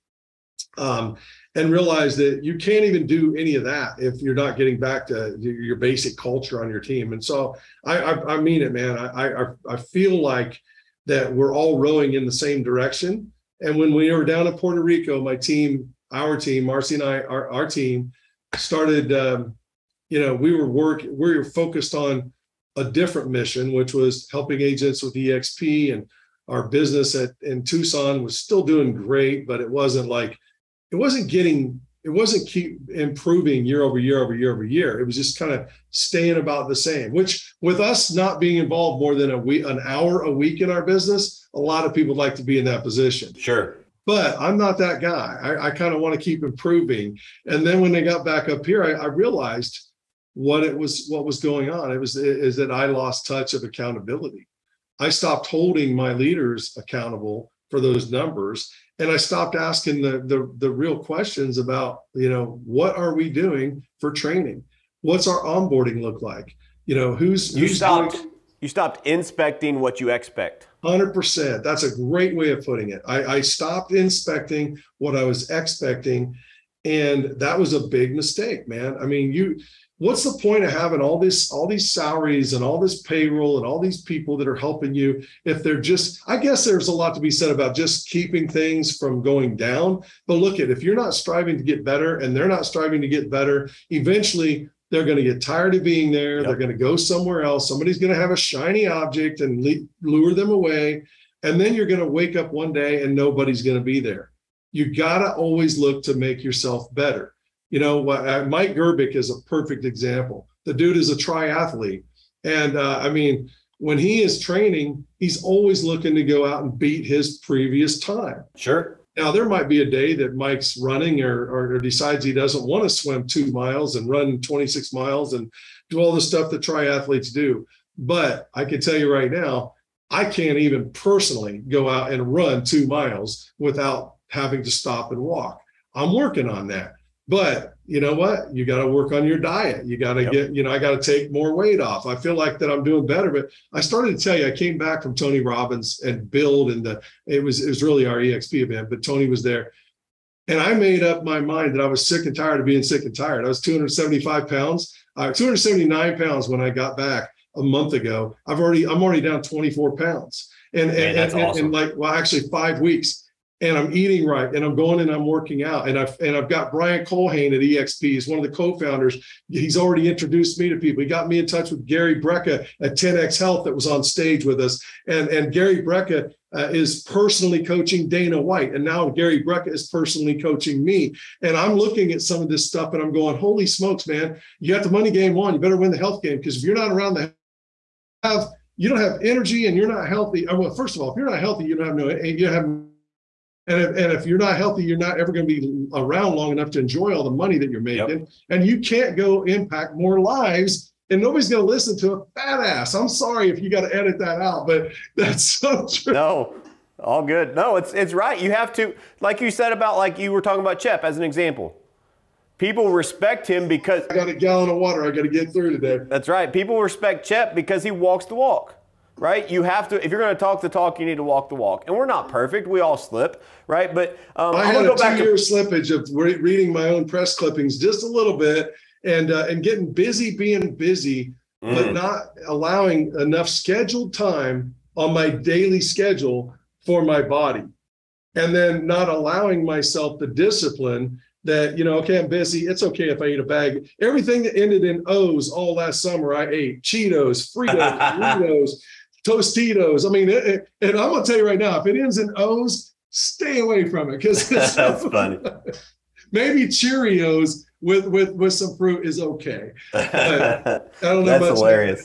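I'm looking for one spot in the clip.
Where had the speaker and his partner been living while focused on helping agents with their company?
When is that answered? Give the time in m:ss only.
0:14.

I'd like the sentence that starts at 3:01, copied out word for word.
And I'm looking at some of this stuff, and I'm going, "Holy smokes, man!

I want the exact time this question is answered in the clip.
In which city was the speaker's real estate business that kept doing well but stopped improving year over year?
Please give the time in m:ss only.
0:27.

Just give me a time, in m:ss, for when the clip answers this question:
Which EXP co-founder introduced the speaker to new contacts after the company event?
2:46.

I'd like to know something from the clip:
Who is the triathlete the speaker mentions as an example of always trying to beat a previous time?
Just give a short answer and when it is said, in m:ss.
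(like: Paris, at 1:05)
Mike Gerbic, at 1:48.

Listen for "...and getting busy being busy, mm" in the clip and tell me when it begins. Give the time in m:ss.
3:49.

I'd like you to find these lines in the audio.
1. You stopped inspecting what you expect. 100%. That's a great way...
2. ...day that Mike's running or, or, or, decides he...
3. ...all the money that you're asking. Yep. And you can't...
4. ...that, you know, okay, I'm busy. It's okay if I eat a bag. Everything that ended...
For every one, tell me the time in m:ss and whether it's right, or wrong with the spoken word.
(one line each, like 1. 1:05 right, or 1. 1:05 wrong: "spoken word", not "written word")
1. 1:08 right
2. 1:59 right
3. 3:17 wrong: "making", not "asking"
4. 4:01 right.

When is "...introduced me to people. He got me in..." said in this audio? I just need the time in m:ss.
2:50.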